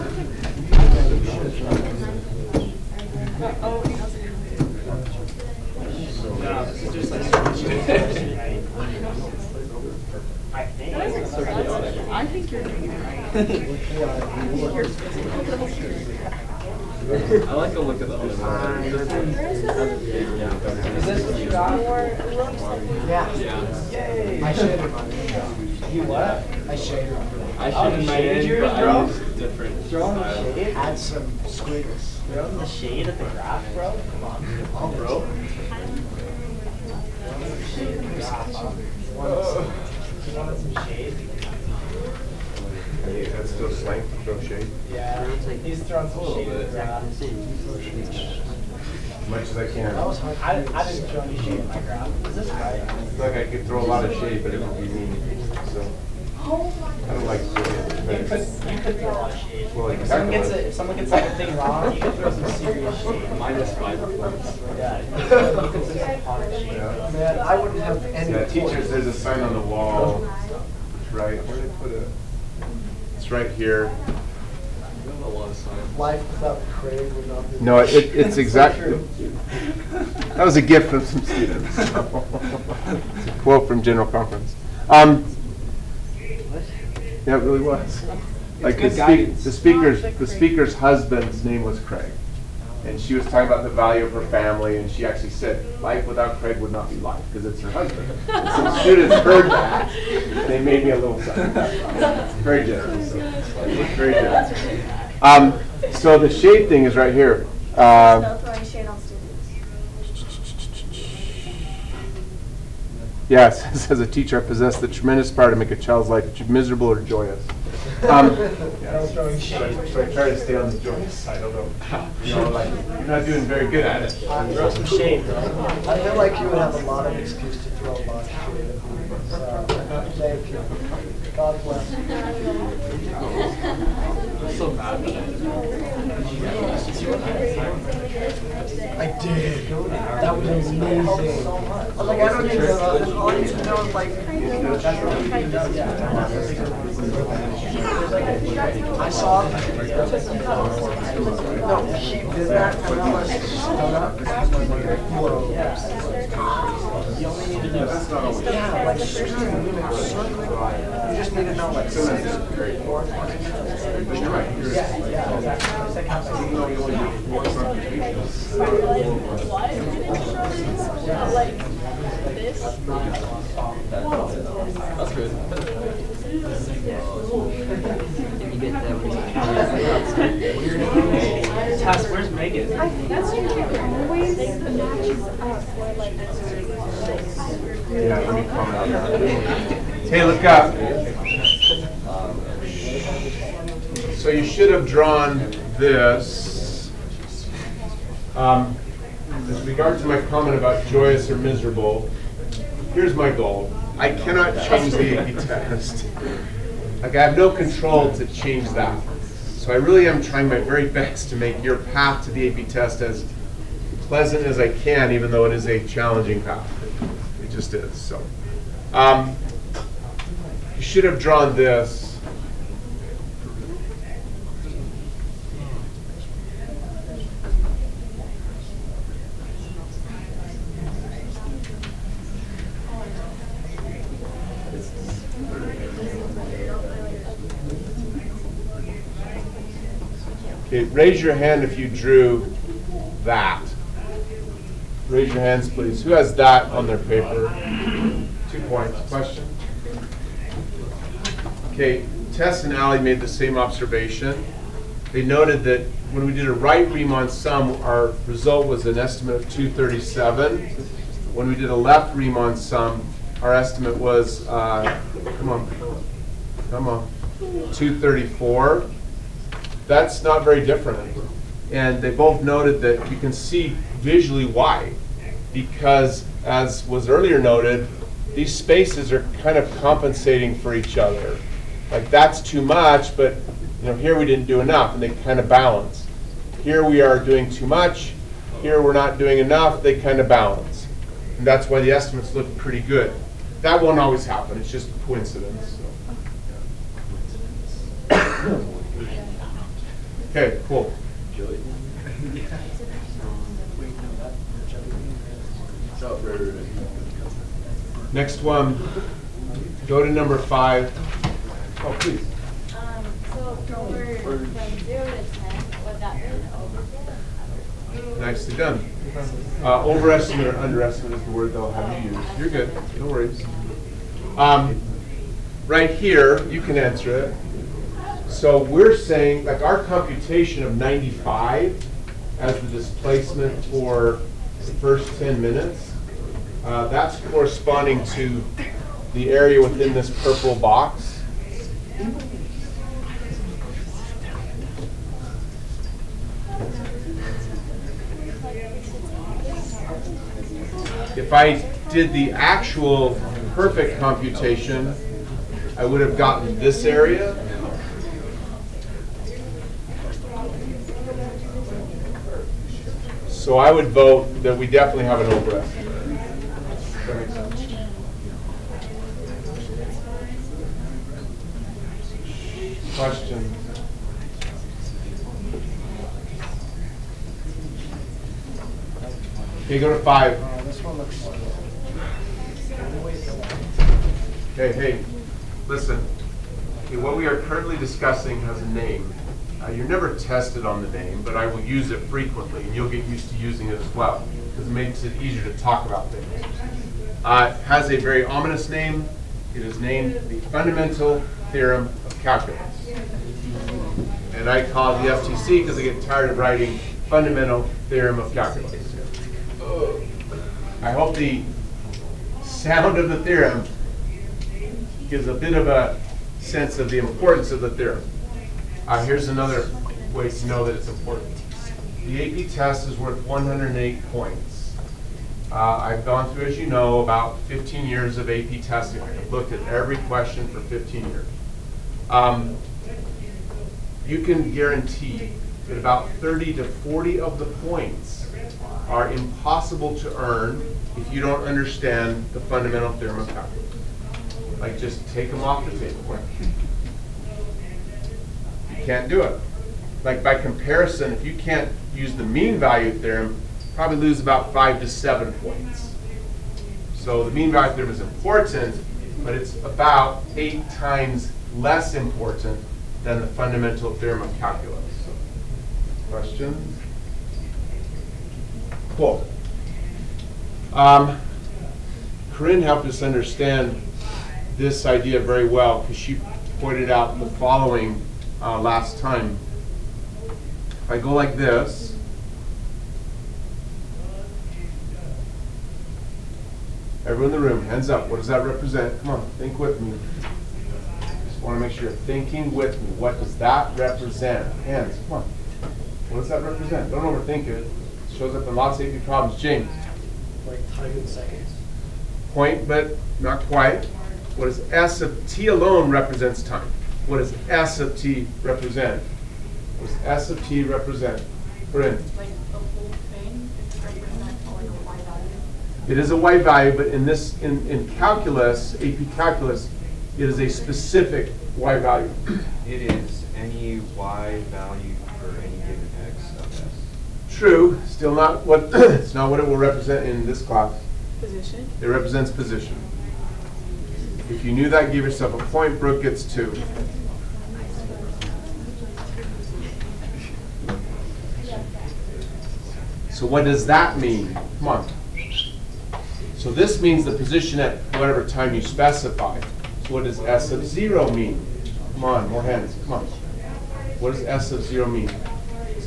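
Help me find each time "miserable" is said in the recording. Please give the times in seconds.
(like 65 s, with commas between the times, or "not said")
116 s, 201 s.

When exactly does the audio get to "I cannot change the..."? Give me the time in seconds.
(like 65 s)
203 s.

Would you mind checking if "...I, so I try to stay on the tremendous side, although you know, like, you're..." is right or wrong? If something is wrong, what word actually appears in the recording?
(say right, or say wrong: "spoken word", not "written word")
wrong: "joyous", not "tremendous".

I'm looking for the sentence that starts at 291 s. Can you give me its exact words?
And that's why the estimates look pretty good.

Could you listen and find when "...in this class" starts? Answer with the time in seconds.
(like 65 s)
530 s.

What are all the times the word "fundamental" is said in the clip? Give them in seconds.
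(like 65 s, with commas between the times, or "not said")
400 s, 407 s, 442 s, 463 s.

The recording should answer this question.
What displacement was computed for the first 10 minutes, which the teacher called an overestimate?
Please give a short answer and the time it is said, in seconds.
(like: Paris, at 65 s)
95, at 330 s.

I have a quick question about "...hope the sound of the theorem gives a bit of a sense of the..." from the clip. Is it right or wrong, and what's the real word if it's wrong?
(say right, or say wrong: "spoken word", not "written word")
right.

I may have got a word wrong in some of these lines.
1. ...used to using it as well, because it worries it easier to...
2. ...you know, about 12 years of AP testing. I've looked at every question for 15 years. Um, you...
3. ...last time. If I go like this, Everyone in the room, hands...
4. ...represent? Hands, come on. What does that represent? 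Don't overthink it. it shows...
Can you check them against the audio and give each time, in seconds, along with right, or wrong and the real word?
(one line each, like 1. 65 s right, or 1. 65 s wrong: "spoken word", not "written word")
1. 393 s wrong: "makes", not "worries"
2. 426 s wrong: "15", not "12"
3. 478 s right
4. 493 s right.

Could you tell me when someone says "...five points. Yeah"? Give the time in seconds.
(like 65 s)
63 s.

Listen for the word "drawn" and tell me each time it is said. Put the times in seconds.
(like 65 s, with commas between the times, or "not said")
194 s, 221 s.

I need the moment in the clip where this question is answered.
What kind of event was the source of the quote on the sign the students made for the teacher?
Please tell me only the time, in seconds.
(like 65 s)
83 s.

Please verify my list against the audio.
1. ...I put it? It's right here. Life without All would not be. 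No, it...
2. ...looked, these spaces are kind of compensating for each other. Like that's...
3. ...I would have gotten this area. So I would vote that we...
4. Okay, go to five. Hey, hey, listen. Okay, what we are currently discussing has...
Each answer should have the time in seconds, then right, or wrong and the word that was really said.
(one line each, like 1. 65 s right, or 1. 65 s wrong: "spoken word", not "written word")
1. 71 s wrong: "Craig", not "All"
2. 277 s wrong: "noted", not "looked"
3. 355 s right
4. 379 s right.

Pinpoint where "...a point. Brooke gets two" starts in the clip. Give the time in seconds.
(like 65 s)
535 s.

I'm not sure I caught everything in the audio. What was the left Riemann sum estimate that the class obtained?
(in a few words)
234.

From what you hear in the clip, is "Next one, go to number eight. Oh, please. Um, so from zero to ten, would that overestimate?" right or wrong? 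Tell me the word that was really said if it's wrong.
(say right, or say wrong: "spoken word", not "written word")
wrong: "five", not "eight".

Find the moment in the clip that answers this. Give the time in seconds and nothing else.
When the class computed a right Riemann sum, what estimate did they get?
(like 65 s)
259 s.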